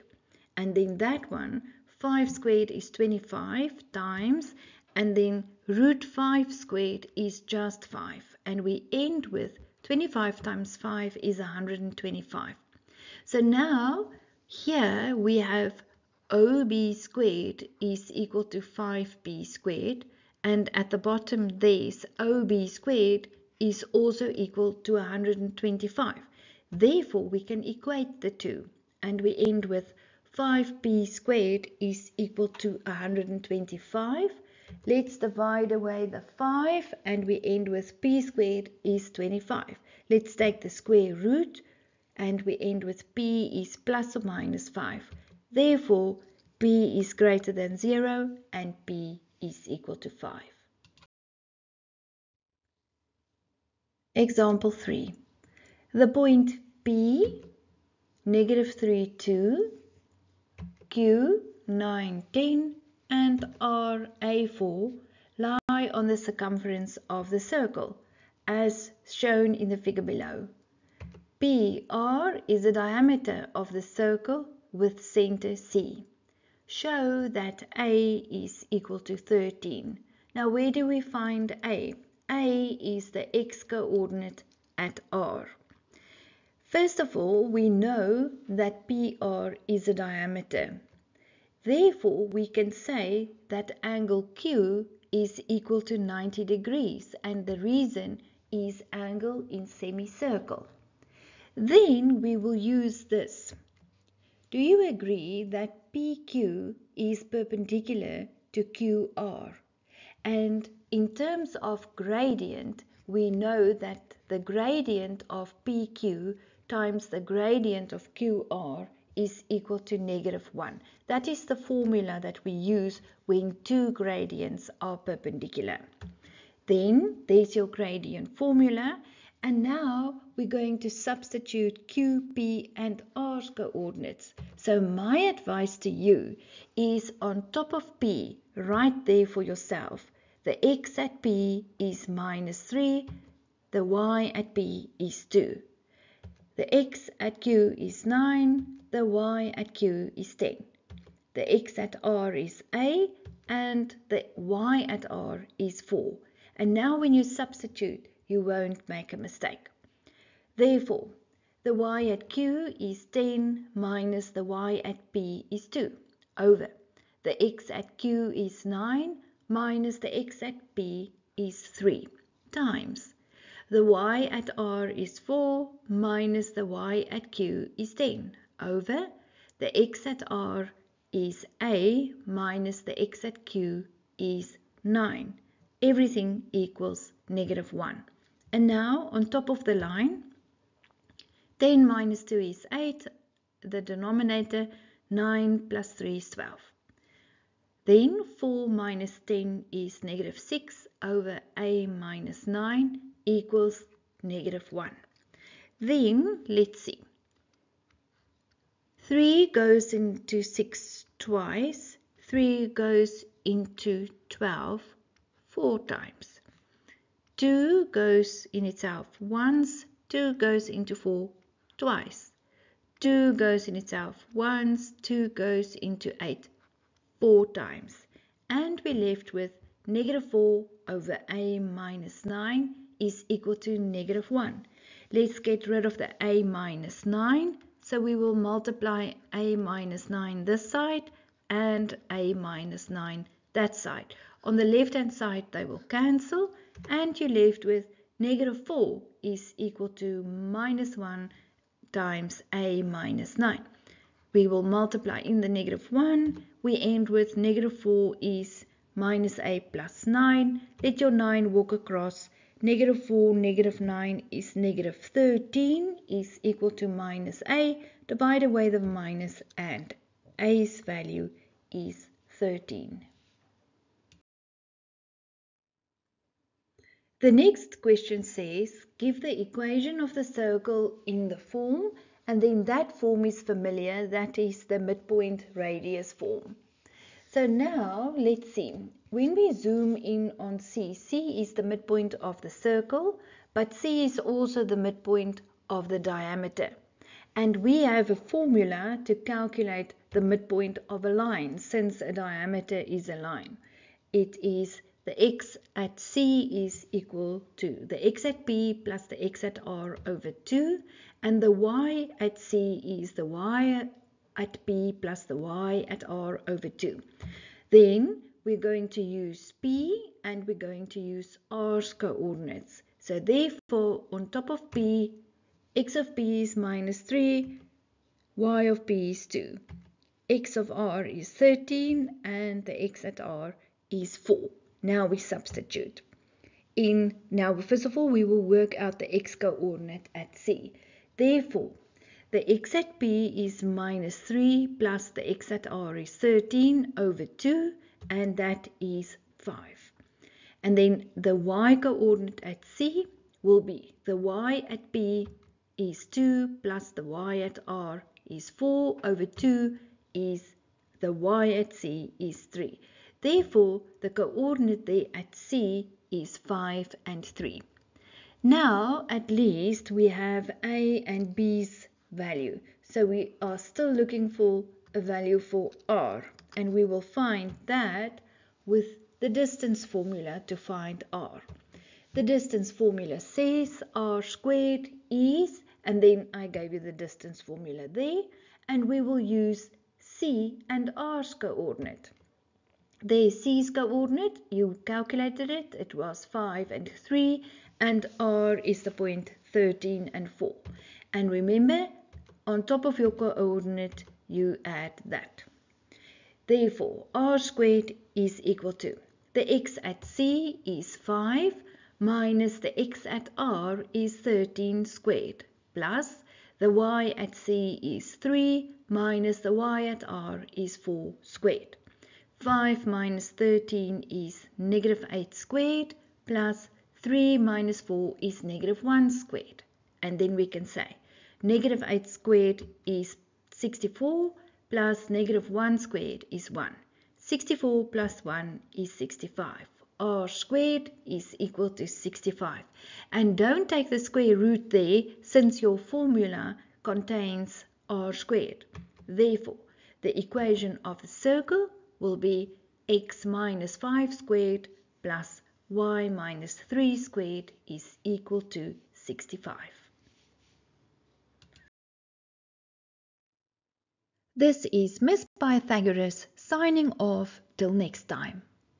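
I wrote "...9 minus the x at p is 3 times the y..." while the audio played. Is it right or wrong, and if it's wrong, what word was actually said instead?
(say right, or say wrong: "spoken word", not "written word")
right.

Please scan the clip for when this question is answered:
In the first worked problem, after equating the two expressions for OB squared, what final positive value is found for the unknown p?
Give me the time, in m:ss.
0:48.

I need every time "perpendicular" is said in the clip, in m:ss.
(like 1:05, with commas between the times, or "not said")
1:47, 2:04.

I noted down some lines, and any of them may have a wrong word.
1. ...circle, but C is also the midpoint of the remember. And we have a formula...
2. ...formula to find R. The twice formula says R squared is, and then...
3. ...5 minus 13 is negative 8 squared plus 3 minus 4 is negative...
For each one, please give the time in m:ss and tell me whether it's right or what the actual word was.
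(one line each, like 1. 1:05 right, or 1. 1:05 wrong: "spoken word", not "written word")
1. 4:52 wrong: "diameter", not "remember"
2. 6:19 wrong: "distance", not "twice"
3. 7:02 right.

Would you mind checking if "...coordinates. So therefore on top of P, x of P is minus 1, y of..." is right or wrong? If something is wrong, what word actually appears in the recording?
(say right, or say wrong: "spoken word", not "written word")
wrong: "3", not "1".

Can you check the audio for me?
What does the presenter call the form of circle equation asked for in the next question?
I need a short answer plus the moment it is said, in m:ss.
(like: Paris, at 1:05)
midpoint radius form, at 4:44.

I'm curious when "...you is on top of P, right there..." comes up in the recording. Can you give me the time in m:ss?
2:15.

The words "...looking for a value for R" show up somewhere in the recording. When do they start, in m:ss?
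6:13.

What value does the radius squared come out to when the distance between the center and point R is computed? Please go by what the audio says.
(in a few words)
65.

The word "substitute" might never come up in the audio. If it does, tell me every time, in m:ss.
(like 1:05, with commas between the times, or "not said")
2:10, 2:37, 5:35.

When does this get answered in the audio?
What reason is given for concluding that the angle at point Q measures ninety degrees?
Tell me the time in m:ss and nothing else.
1:38.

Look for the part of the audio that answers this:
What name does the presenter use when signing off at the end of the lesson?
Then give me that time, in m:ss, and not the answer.
7:44.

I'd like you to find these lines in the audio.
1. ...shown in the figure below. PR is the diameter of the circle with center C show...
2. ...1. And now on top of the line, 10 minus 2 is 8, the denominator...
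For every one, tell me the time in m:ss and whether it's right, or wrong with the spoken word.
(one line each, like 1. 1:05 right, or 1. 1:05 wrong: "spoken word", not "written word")
1. 1:09 right
2. 3:07 right.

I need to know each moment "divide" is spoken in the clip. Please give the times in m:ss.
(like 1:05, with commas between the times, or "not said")
0:35, 4:28.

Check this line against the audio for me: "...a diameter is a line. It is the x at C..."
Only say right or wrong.
right.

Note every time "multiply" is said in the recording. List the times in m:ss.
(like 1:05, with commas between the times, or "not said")
3:58, 4:14.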